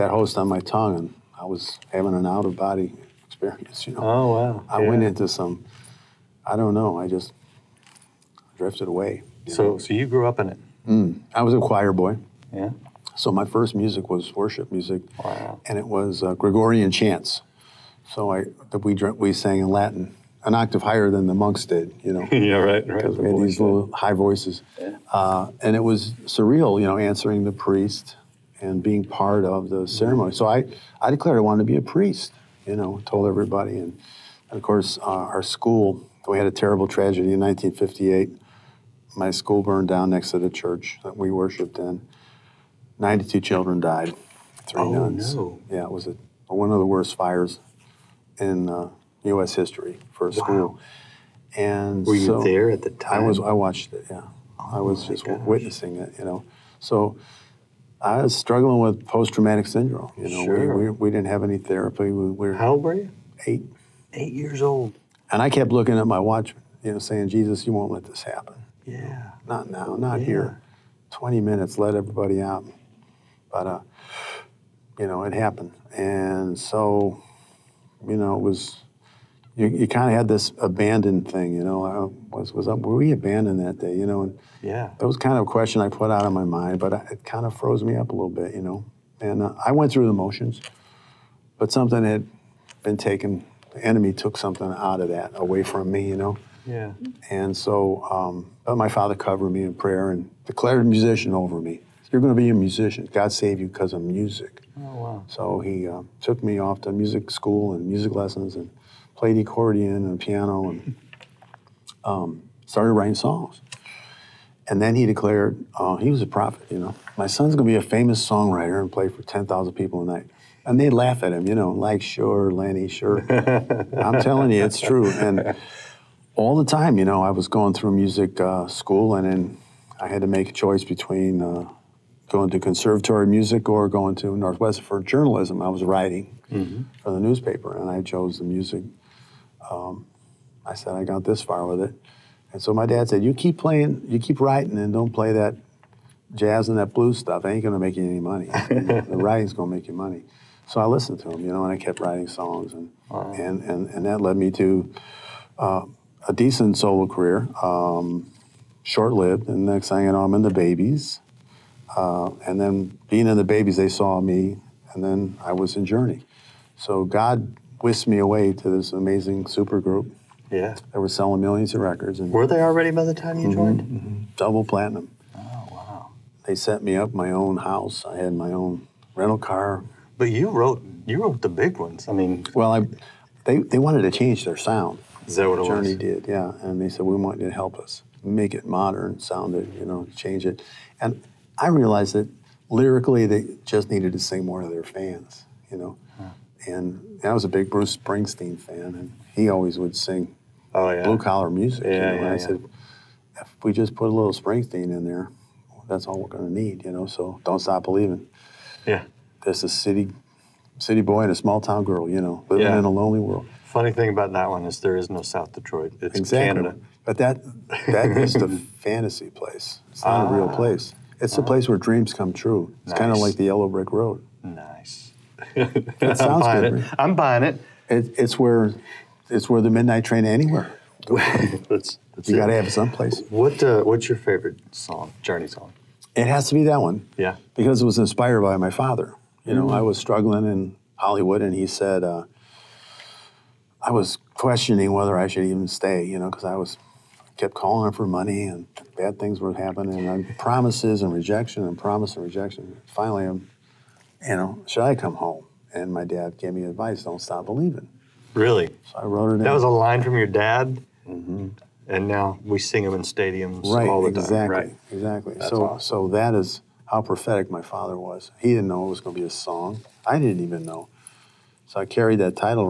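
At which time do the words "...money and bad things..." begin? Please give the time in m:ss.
4:08.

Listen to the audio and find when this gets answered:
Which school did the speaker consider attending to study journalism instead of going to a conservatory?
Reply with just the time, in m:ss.
2:14.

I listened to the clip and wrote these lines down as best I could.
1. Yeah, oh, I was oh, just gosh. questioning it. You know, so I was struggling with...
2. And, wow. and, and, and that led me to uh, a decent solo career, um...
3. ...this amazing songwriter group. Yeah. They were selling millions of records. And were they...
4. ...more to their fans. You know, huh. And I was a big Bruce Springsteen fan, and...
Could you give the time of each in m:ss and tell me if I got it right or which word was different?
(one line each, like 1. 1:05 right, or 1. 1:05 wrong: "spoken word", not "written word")
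1. 0:54 wrong: "witnessing", not "questioning"
2. 2:32 right
3. 2:48 wrong: "super", not "songwriter"
4. 3:14 right.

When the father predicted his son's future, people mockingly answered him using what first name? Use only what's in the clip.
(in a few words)
Lenny.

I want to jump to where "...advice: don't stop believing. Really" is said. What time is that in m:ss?
4:16.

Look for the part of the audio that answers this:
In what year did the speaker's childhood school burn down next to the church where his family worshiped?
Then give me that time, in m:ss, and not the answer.
0:37.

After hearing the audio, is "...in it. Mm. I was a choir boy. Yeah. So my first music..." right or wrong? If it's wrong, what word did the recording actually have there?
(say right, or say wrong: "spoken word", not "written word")
right.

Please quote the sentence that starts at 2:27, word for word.
ain't gonna make you any money.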